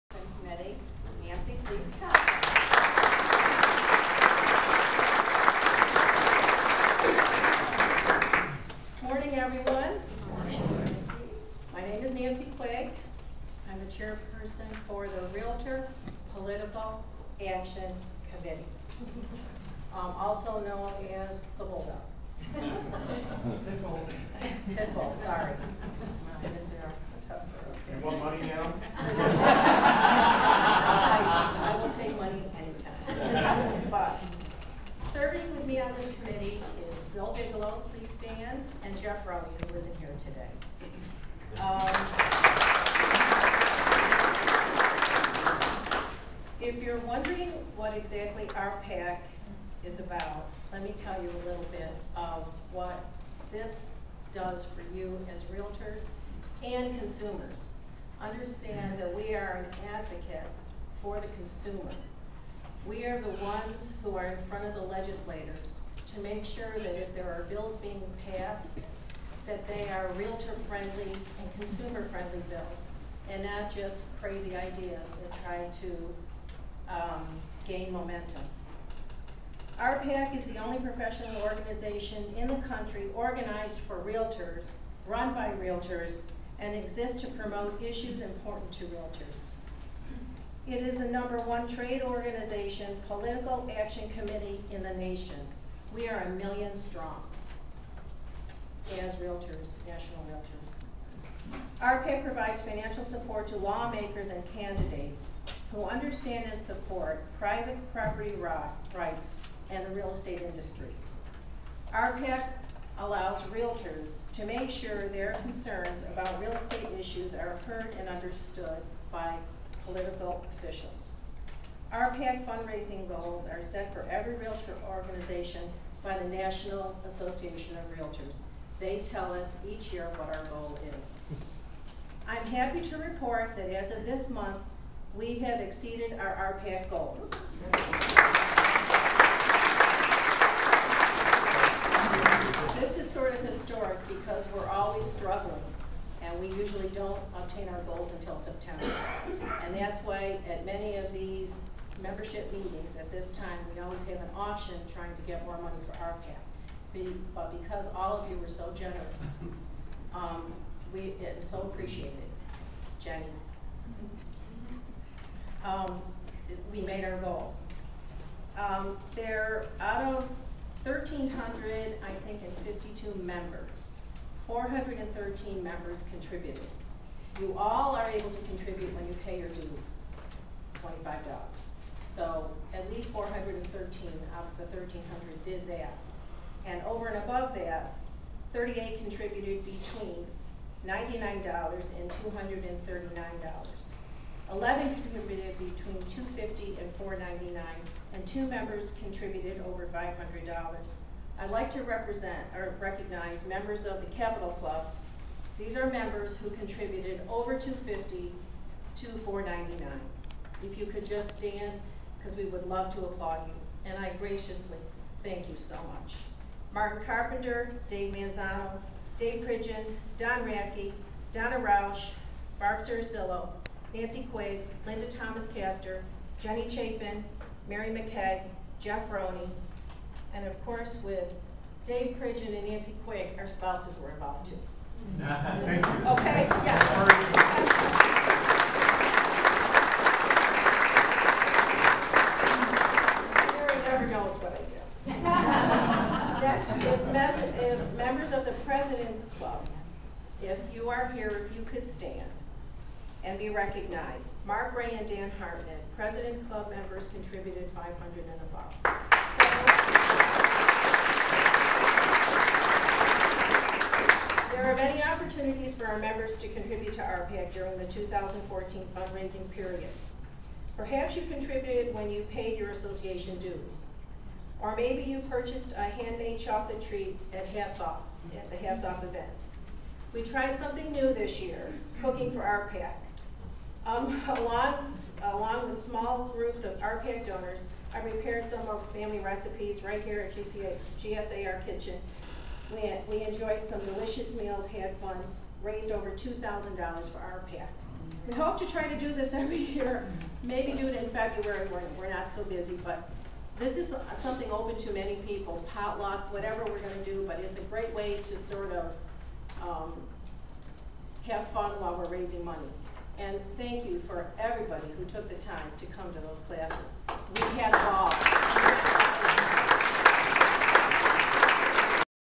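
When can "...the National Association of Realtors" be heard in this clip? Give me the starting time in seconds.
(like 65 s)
126 s.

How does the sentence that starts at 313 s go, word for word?
And thank you for everybody who took the time to come to those classes.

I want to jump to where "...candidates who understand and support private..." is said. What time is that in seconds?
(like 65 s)
104 s.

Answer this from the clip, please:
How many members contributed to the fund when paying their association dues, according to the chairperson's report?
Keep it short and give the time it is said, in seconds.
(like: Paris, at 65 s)
413, at 174 s.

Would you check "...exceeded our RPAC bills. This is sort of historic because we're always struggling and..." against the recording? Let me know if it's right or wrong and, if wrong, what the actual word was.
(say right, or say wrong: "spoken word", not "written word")
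wrong: "goals", not "bills".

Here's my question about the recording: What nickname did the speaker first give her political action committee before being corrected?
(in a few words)
Bulldog.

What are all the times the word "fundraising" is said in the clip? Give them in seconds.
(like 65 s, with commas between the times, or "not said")
122 s, 268 s.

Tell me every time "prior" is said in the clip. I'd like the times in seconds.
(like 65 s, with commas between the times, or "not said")
not said.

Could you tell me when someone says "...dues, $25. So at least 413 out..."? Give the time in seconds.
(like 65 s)
179 s.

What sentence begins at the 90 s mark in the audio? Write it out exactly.
It is the number one trade organization political action committee in the nation.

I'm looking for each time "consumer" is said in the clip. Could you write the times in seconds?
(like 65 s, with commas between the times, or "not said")
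56 s, 61 s, 71 s.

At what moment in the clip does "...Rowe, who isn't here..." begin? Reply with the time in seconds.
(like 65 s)
39 s.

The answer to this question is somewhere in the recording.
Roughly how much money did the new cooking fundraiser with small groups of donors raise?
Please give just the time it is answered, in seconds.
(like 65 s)
295 s.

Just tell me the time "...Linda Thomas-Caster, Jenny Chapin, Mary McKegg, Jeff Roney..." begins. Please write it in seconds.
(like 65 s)
224 s.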